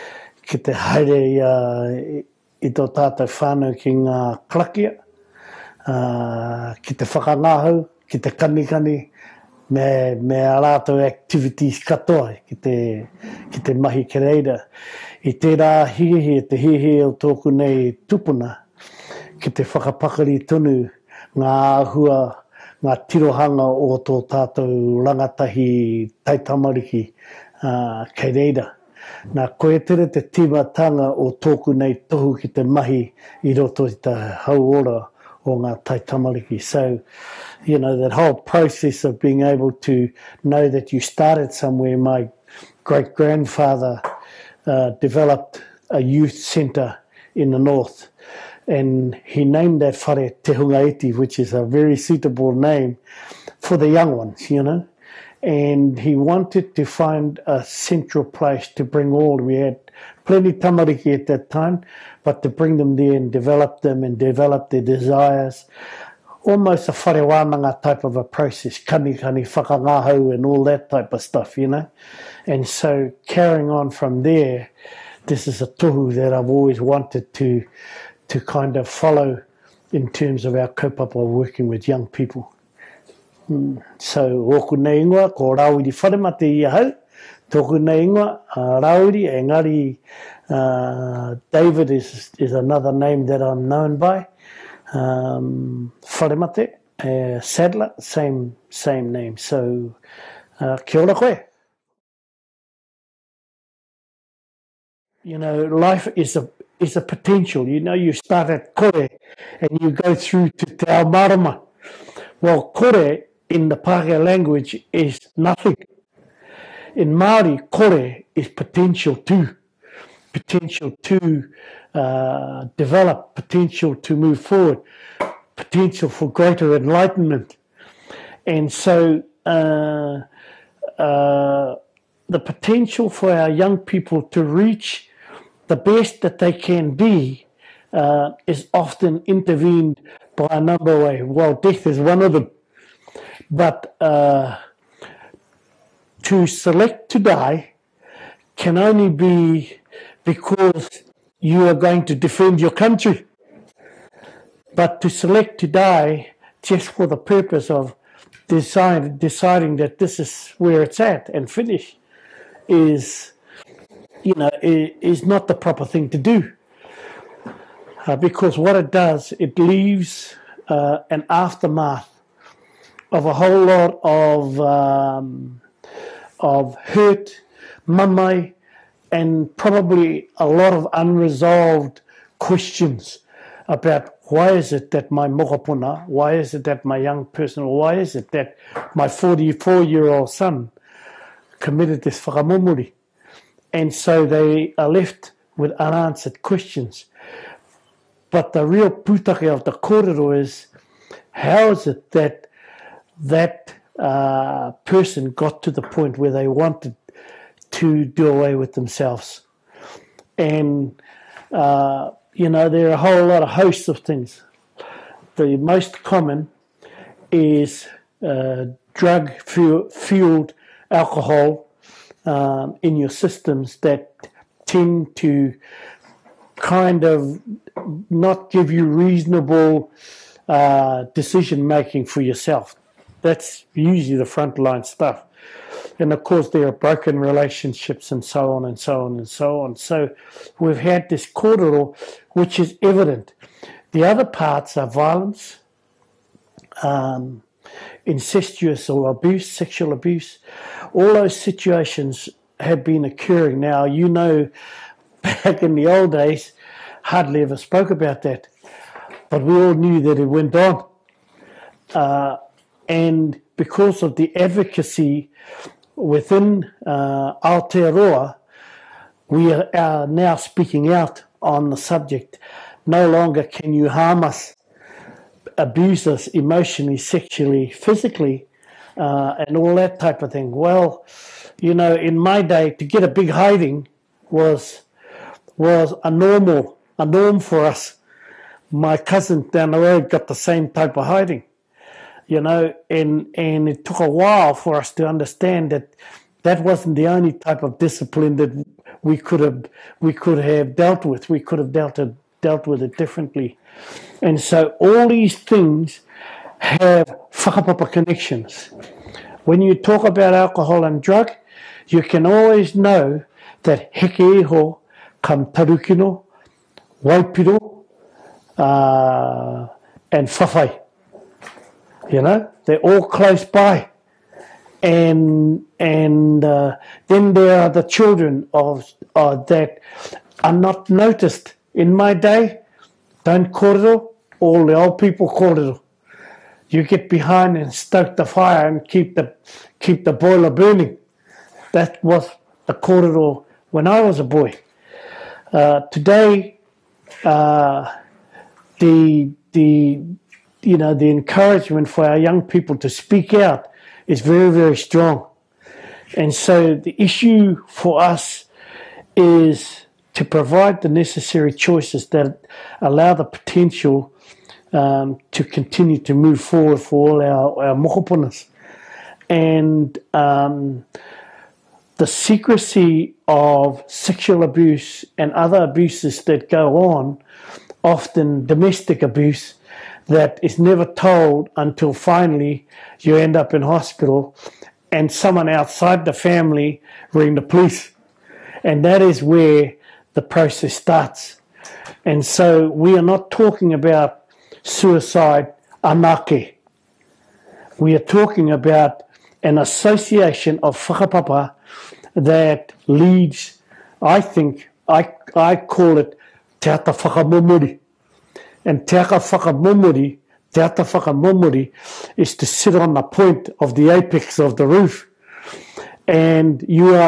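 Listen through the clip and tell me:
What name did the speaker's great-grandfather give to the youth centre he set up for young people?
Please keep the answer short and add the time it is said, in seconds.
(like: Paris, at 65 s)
Te Hungaiti, at 50 s.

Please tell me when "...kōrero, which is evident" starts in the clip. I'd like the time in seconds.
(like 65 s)
241 s.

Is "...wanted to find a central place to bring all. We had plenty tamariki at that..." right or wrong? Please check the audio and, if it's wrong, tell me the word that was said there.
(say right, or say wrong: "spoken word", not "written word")
right.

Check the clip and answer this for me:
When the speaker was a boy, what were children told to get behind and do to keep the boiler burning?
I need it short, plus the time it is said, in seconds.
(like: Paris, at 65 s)
stoke the fire, at 337 s.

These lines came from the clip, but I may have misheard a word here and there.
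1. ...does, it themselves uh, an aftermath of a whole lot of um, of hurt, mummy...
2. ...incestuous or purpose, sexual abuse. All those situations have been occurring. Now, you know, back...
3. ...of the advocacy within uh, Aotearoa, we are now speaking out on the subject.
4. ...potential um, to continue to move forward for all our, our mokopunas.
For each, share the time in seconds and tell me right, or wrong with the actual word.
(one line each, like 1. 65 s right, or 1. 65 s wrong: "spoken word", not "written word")
1. 168 s wrong: "leaves", not "themselves"
2. 248 s wrong: "abuse", not "purpose"
3. 264 s right
4. 363 s right.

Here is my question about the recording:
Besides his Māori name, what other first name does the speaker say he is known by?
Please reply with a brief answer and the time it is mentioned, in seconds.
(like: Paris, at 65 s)
David, at 91 s.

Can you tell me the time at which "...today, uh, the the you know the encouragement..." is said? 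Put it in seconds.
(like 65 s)
345 s.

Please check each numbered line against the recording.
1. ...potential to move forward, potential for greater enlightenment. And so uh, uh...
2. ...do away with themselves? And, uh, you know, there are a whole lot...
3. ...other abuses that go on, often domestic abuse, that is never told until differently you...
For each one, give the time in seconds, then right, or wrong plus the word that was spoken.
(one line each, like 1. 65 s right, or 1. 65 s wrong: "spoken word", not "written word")
1. 123 s right
2. 208 s right
3. 375 s wrong: "finally", not "differently".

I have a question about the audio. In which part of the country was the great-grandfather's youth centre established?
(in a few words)
the north.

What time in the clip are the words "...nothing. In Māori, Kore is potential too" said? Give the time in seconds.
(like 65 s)
115 s.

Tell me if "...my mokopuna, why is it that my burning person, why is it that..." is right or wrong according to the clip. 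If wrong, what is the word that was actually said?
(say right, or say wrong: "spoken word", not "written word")
wrong: "young", not "burning".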